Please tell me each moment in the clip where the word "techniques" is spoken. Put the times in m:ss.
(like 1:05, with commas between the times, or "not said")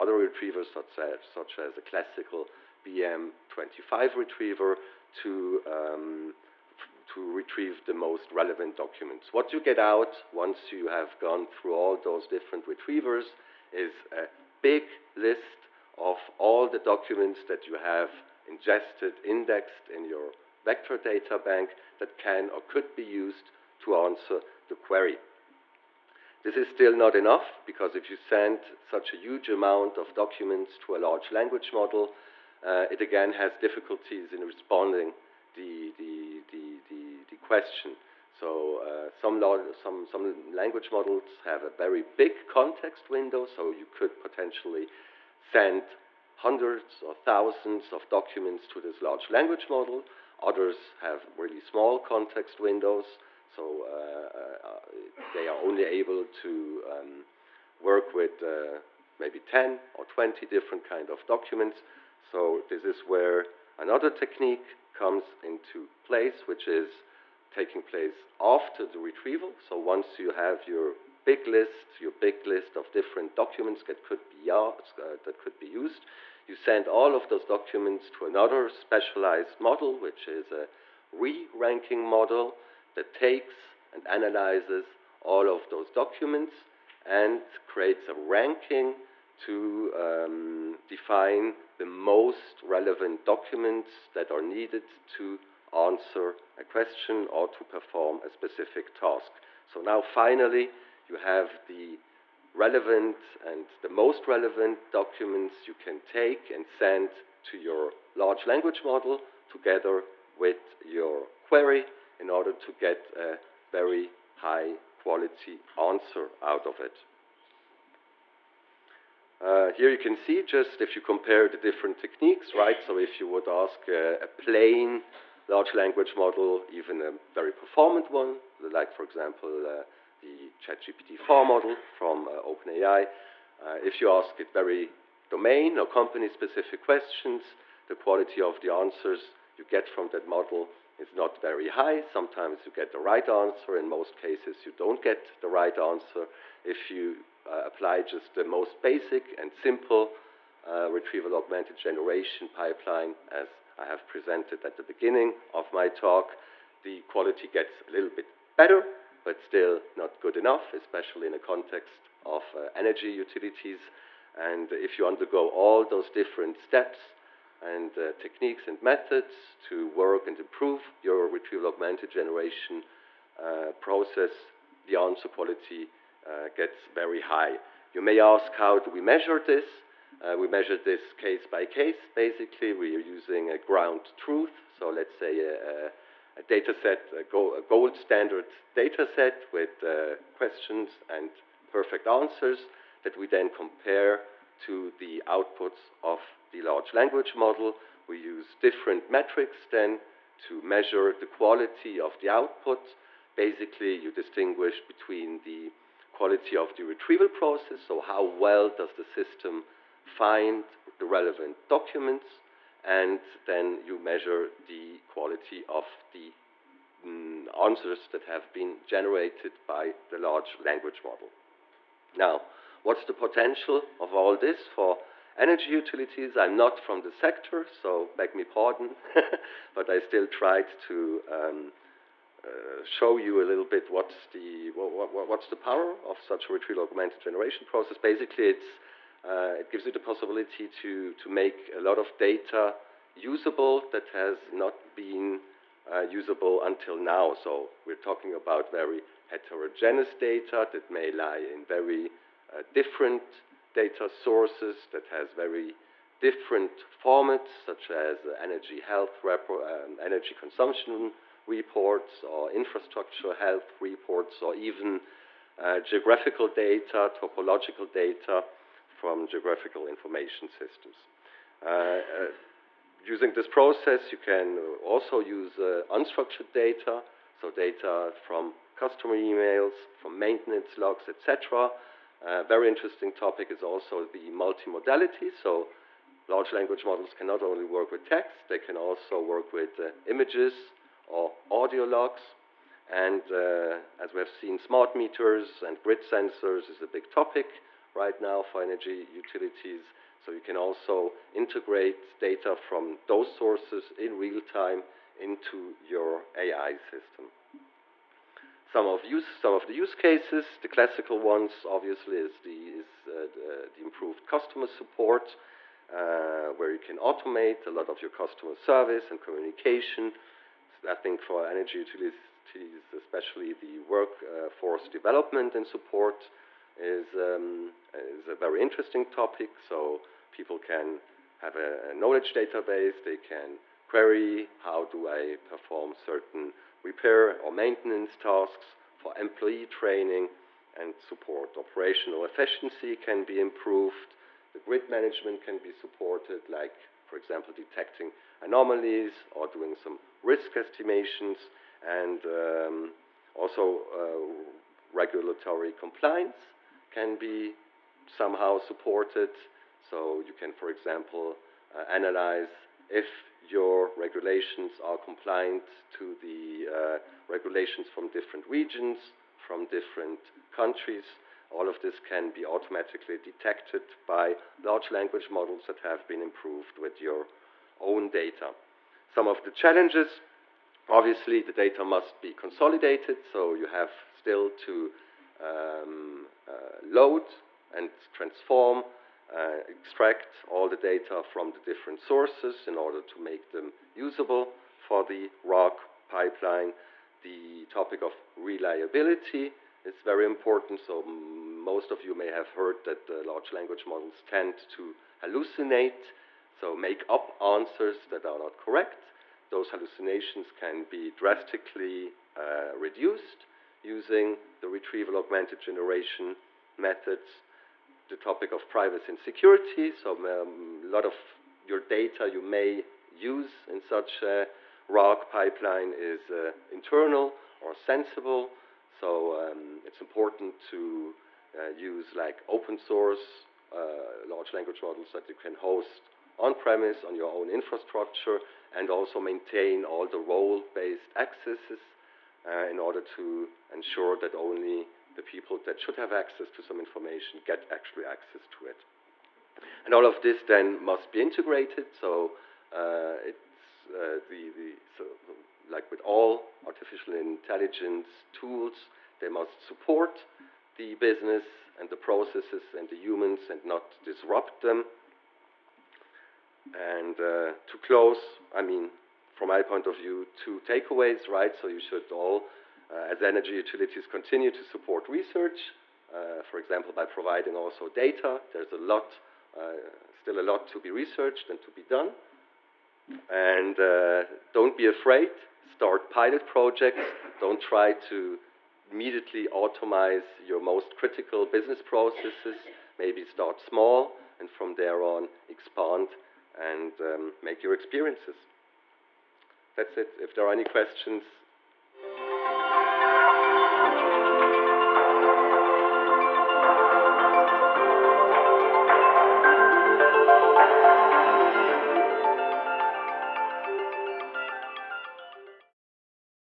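1:04, 2:01, 2:48.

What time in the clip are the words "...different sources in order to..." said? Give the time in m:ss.
6:31.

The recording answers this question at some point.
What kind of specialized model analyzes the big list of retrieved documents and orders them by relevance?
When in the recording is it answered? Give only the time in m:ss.
1:21.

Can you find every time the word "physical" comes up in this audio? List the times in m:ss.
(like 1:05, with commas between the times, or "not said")
not said.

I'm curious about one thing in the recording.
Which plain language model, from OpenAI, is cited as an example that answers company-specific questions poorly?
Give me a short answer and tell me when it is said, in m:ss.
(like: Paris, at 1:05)
ChatGPT 4, at 2:10.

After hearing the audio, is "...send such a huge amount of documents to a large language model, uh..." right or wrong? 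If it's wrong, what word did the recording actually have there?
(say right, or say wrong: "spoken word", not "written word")
right.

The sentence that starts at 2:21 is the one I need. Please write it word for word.
Sometimes you get the right answer.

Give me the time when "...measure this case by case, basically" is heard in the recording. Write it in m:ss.
3:00.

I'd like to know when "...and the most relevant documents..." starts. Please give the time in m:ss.
1:43.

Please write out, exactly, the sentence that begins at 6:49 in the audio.
Those hallucinations can be drastically uh, reduced using the retrieval augmented generation methods the topic of privacy and security.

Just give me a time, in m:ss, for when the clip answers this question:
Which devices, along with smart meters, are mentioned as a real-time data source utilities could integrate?
4:55.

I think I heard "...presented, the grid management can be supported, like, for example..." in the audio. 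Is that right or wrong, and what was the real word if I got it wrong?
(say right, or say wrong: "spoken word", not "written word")
wrong: "improved", not "presented".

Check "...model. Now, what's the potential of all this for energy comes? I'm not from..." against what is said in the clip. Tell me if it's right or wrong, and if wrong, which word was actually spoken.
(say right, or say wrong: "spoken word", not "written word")
wrong: "utilities", not "comes".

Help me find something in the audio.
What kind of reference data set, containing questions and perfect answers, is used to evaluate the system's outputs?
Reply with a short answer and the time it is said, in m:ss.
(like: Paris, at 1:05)
Gold standard data set, at 3:07.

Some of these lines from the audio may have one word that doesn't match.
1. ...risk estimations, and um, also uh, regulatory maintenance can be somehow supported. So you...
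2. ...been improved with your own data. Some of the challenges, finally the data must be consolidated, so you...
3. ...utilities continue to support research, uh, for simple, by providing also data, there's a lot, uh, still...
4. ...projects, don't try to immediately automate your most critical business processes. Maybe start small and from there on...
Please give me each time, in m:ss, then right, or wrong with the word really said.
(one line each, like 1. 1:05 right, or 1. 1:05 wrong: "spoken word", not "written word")
1. 5:50 wrong: "compliance", not "maintenance"
2. 6:16 wrong: "obviously", not "finally"
3. 7:53 wrong: "example", not "simple"
4. 8:06 right.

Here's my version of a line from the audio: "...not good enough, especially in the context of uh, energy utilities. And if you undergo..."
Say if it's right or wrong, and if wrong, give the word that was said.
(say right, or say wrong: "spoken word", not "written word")
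right.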